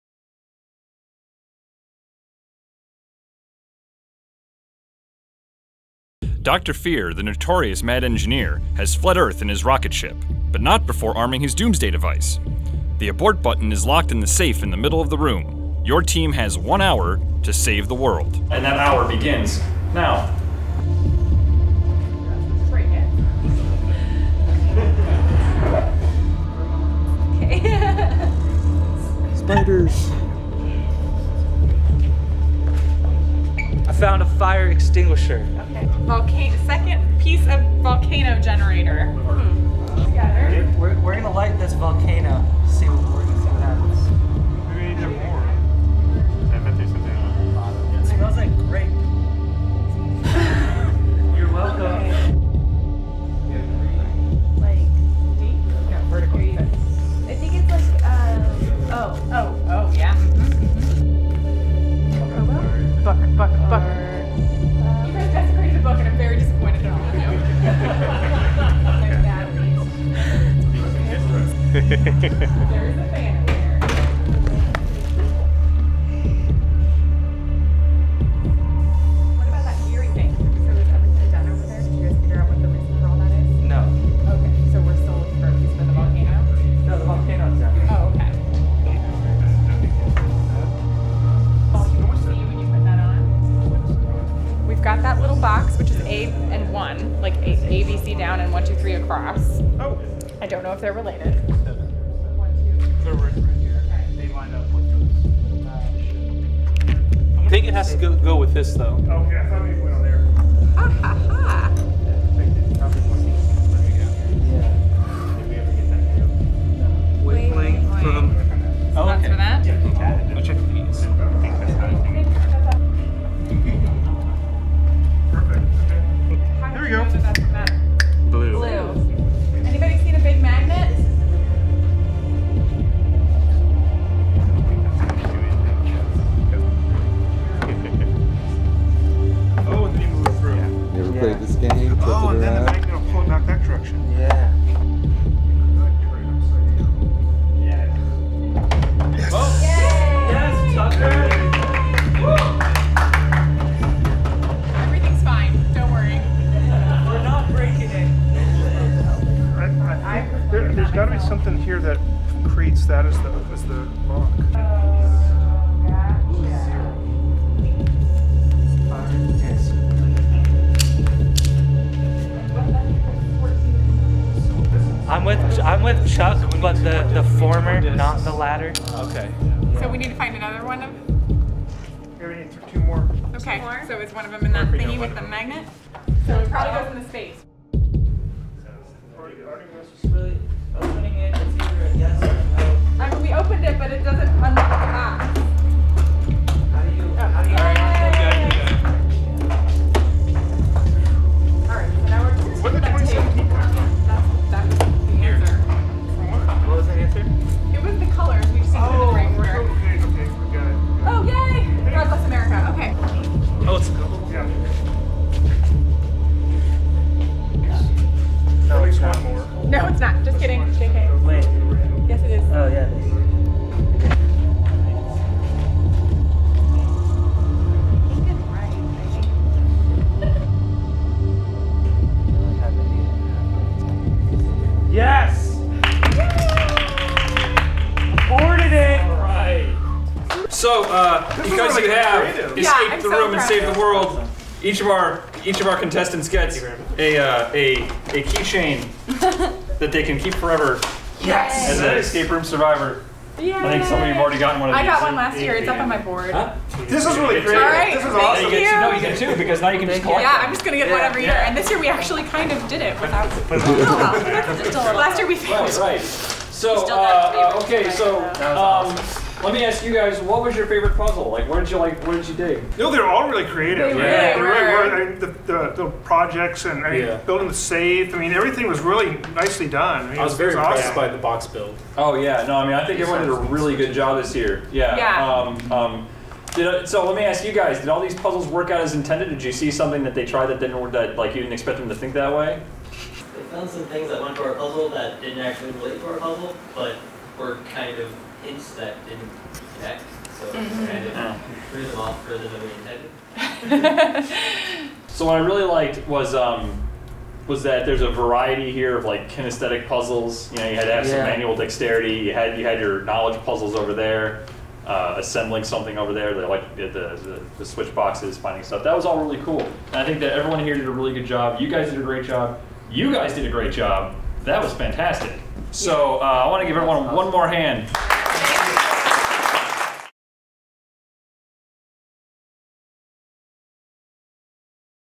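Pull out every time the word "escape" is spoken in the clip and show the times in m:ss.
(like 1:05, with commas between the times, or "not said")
4:02, 4:11.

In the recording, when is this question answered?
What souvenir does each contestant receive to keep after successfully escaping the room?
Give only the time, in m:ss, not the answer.
4:08.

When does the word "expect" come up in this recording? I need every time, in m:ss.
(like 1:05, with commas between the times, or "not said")
4:51.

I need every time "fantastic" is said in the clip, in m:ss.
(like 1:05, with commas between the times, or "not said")
5:24.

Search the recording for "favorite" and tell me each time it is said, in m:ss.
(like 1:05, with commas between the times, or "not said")
4:30.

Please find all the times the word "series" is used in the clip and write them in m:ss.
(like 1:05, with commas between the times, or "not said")
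not said.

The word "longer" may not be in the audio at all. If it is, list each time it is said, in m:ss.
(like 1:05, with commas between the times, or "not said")
not said.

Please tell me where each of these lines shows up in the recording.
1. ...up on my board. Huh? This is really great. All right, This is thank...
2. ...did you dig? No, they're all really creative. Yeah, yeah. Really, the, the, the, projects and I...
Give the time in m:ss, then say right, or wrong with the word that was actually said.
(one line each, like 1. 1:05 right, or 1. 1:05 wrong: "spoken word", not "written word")
1. 4:15 right
2. 4:32 right.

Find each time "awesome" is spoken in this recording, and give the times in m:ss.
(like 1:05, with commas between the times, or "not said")
4:18, 4:40.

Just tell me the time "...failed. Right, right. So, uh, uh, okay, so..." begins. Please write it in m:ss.
4:25.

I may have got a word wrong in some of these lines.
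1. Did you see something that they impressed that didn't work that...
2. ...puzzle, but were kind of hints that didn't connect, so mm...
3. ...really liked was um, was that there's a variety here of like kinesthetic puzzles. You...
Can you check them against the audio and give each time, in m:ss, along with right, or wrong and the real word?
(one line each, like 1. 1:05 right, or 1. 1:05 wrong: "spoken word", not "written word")
1. 4:49 wrong: "tried", not "impressed"
2. 4:56 right
3. 5:05 right.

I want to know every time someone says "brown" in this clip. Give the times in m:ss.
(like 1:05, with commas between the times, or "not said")
not said.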